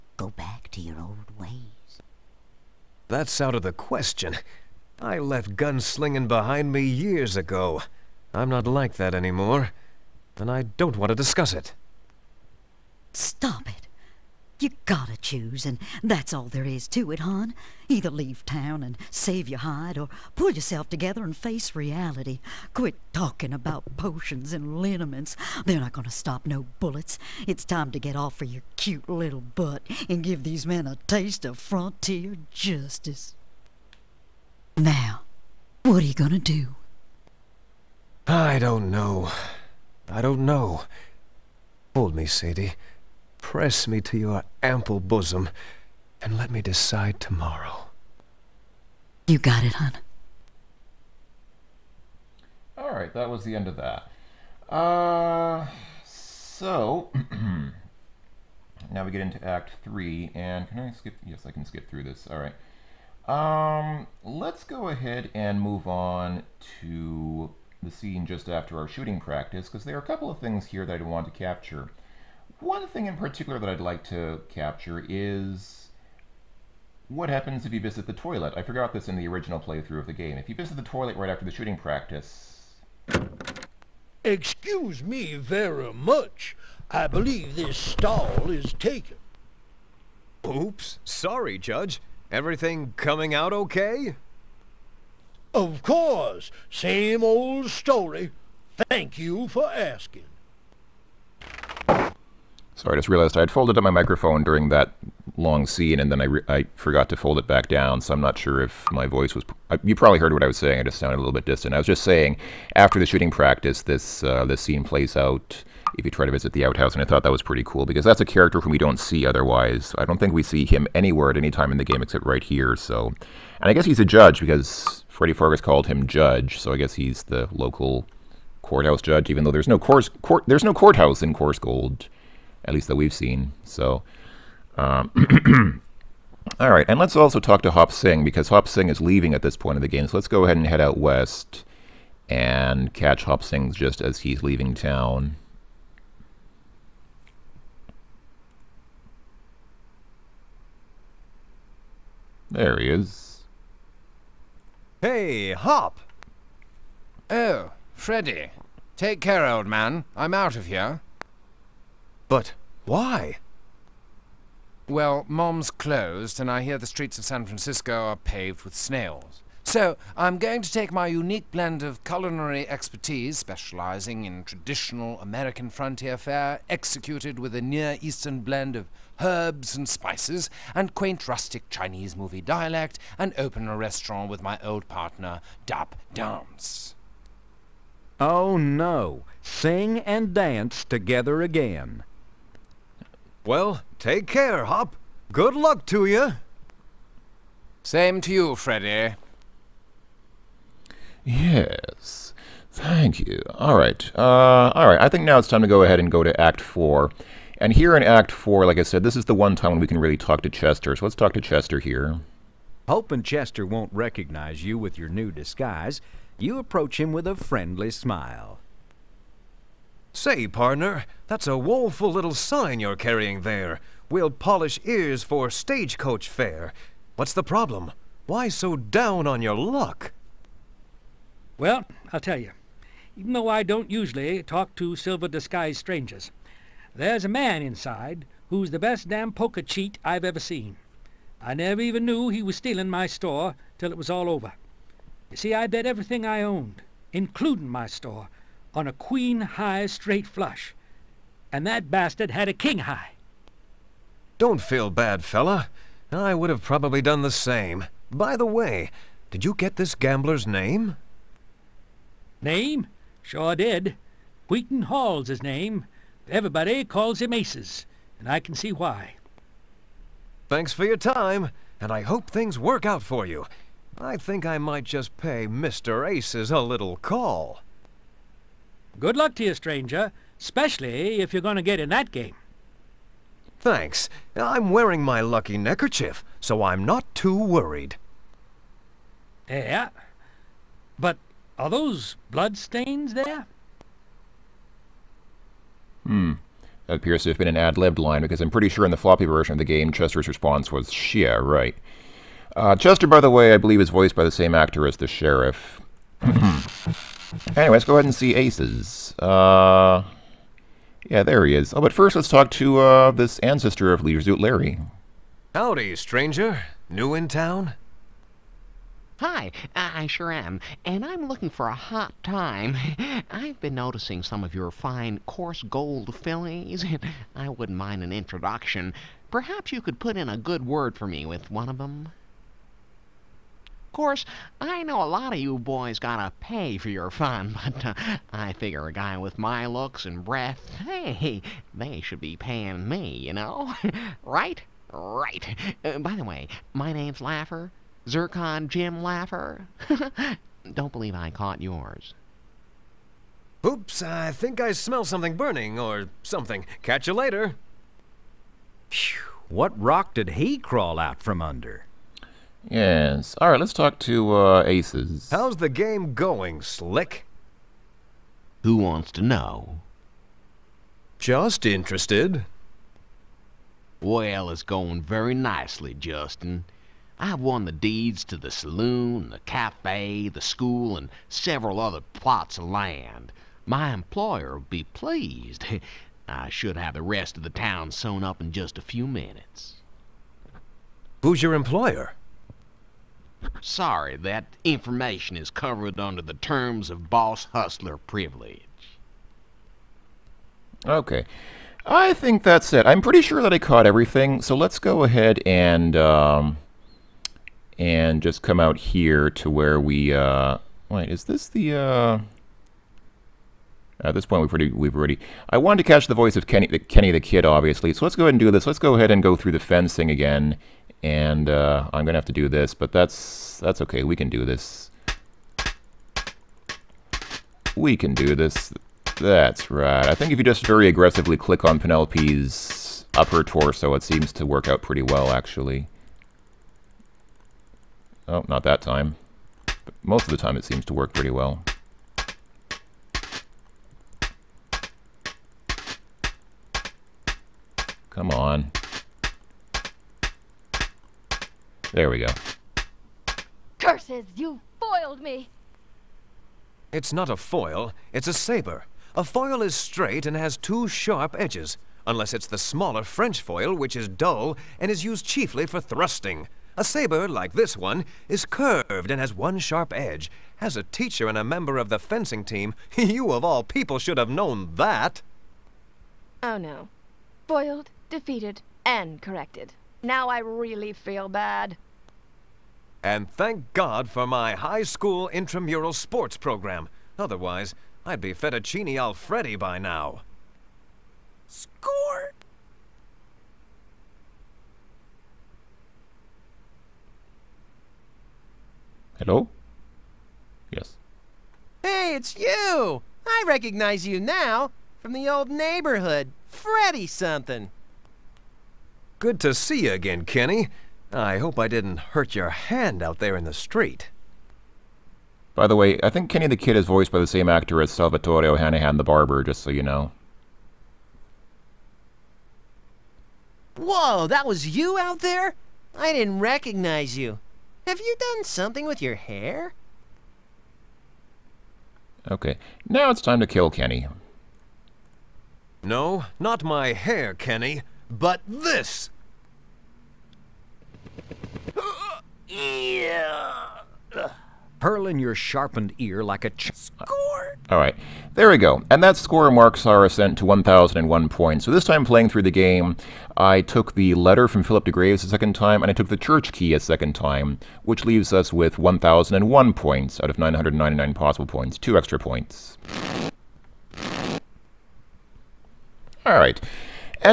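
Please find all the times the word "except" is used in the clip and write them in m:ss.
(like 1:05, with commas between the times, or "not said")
2:02.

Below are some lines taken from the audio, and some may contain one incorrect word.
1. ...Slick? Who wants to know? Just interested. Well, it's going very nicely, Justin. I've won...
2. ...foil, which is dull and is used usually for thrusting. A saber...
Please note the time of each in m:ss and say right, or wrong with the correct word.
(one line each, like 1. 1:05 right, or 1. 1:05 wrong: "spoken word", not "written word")
1. 6:06 right
2. 7:43 wrong: "chiefly", not "usually".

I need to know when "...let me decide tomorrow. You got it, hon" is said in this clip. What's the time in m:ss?
0:46.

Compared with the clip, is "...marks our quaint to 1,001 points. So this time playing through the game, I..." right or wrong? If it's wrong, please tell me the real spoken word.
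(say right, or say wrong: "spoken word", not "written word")
wrong: "ascent", not "quaint".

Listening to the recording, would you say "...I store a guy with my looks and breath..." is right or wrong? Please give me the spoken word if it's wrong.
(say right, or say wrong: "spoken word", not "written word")
wrong: "figure", not "store".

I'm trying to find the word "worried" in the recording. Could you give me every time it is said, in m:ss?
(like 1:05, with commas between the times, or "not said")
4:47.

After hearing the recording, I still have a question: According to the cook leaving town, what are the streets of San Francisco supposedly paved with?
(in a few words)
snails.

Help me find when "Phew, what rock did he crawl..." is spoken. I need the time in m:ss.
5:58.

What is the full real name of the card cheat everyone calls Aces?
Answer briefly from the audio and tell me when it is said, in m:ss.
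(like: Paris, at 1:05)
Wheaton Hall, at 4:24.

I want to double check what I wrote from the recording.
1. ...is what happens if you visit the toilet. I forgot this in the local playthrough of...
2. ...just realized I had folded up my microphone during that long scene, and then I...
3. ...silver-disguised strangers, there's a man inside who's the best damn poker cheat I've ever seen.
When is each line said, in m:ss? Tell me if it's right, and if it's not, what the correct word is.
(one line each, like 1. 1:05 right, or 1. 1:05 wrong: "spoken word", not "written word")
1. 1:15 wrong: "original", not "local"
2. 1:42 right
3. 3:54 right.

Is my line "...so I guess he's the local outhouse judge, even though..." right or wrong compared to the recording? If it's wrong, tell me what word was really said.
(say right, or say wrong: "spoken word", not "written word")
wrong: "courthouse", not "outhouse".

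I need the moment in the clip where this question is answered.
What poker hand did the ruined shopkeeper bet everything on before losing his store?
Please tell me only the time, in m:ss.
4:08.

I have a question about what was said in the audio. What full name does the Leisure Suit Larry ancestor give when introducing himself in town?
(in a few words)
Zircon Jim Laffer.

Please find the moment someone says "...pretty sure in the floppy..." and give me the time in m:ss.
4:58.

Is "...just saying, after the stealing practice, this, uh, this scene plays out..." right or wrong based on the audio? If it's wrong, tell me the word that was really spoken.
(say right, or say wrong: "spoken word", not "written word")
wrong: "shooting", not "stealing".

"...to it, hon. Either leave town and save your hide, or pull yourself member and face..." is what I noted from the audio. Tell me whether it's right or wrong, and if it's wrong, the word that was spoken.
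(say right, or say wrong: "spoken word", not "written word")
wrong: "together", not "member".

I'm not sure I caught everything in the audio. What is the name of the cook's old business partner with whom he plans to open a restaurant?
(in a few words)
Dap Dance.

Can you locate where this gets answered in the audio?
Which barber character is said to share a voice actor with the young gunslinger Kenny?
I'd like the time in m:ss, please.
8:37.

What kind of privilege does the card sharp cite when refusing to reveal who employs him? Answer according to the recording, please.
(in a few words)
boss hustler privilege.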